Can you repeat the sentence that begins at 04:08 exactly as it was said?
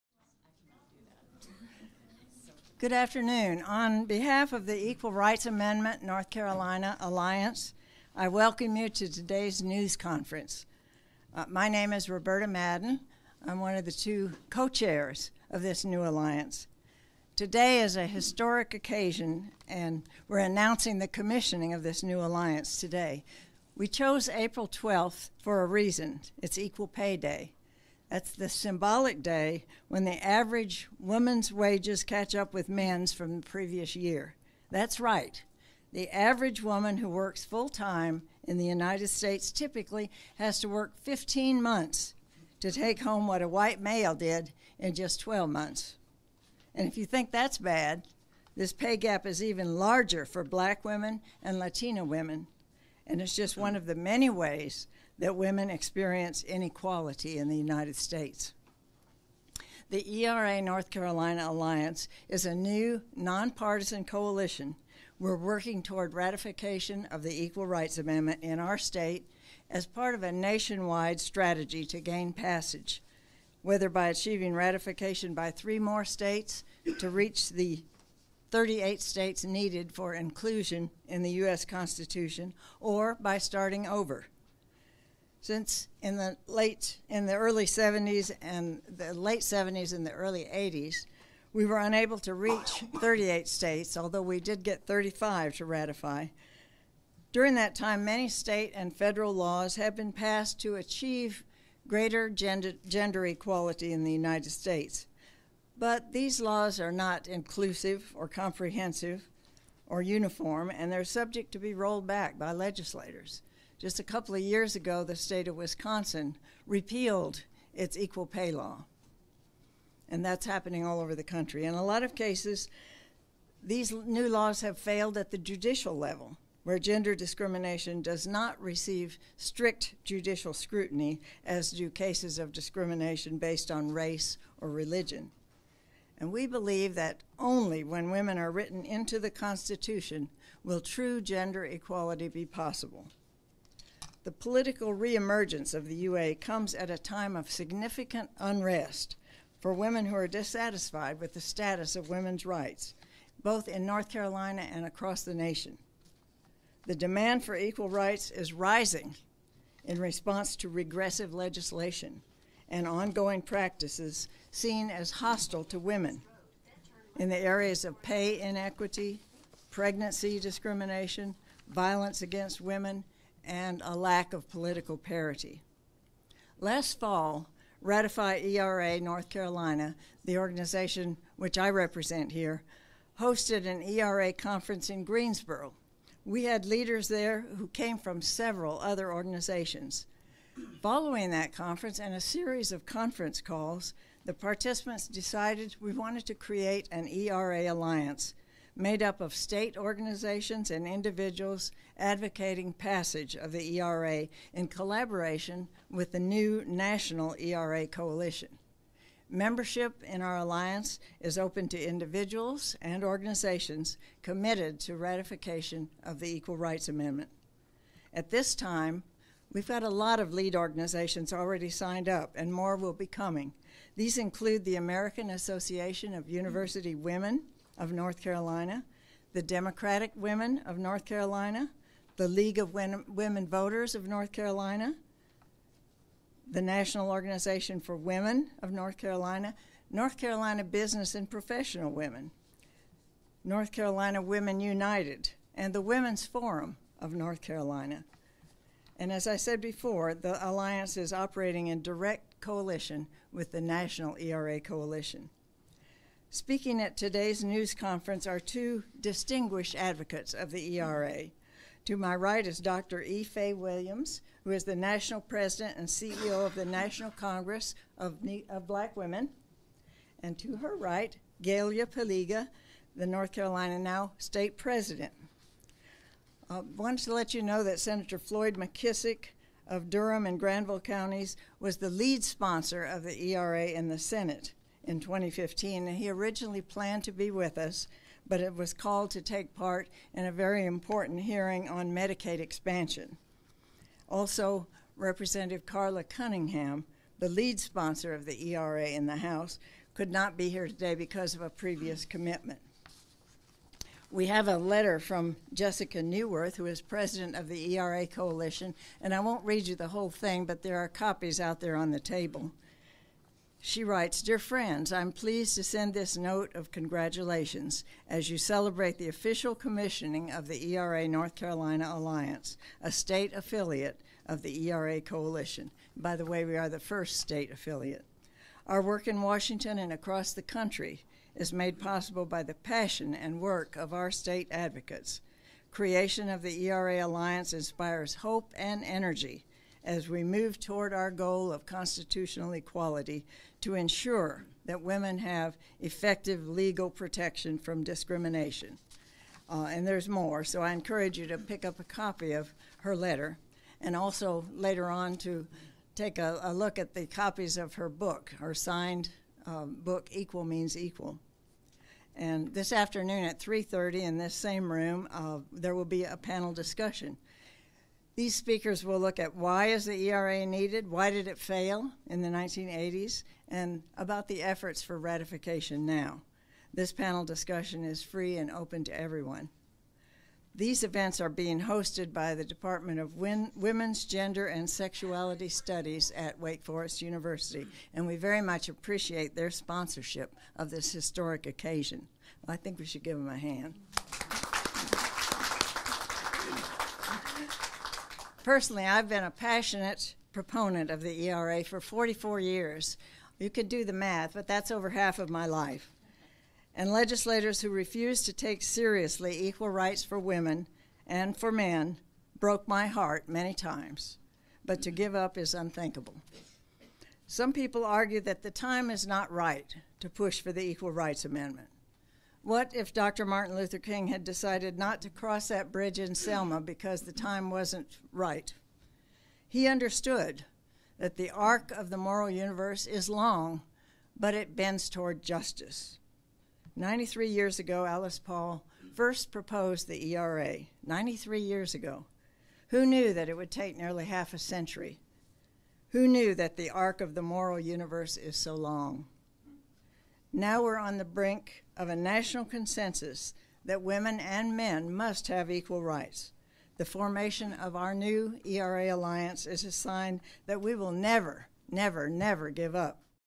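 And as I said before, the Alliance is operating in direct coalition with the National ERA Coalition.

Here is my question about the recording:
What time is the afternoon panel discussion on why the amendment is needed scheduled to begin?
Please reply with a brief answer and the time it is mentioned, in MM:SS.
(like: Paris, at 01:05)
3:30, at 06:03.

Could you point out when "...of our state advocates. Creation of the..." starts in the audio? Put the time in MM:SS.
05:33.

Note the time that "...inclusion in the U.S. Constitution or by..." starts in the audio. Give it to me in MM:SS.
01:20.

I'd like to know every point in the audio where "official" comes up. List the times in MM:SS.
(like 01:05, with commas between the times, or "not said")
05:19.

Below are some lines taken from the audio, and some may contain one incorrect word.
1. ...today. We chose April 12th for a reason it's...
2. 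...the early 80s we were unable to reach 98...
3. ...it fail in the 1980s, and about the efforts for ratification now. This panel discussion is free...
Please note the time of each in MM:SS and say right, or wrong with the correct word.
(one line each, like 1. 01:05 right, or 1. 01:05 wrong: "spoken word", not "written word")
1. 00:22 right
2. 01:30 wrong: "38", not "98"
3. 06:11 right.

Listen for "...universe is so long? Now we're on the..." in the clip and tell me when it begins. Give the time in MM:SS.
07:27.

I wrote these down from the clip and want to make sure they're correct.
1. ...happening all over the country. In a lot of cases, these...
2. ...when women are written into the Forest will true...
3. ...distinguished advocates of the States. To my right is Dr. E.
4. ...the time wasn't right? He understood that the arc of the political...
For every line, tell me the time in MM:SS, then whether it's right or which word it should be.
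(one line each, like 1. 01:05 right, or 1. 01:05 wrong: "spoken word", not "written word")
1. 02:00 right
2. 02:17 wrong: "Constitution", not "Forest"
3. 04:19 wrong: "ERA", not "States"
4. 07:07 wrong: "moral", not "political".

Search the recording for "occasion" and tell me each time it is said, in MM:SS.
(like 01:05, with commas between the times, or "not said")
00:18, 06:31.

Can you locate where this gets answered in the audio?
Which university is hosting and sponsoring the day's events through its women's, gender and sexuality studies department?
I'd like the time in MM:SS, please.
06:26.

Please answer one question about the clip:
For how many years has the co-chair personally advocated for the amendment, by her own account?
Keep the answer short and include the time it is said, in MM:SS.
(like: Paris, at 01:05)
44, at 06:41.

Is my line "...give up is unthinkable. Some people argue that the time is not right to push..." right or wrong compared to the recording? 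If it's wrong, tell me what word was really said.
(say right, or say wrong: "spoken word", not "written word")
right.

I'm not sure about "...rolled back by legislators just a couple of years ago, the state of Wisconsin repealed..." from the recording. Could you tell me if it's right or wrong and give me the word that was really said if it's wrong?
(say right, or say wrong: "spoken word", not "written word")
right.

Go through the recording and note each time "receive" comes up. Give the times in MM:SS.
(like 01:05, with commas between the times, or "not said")
02:08.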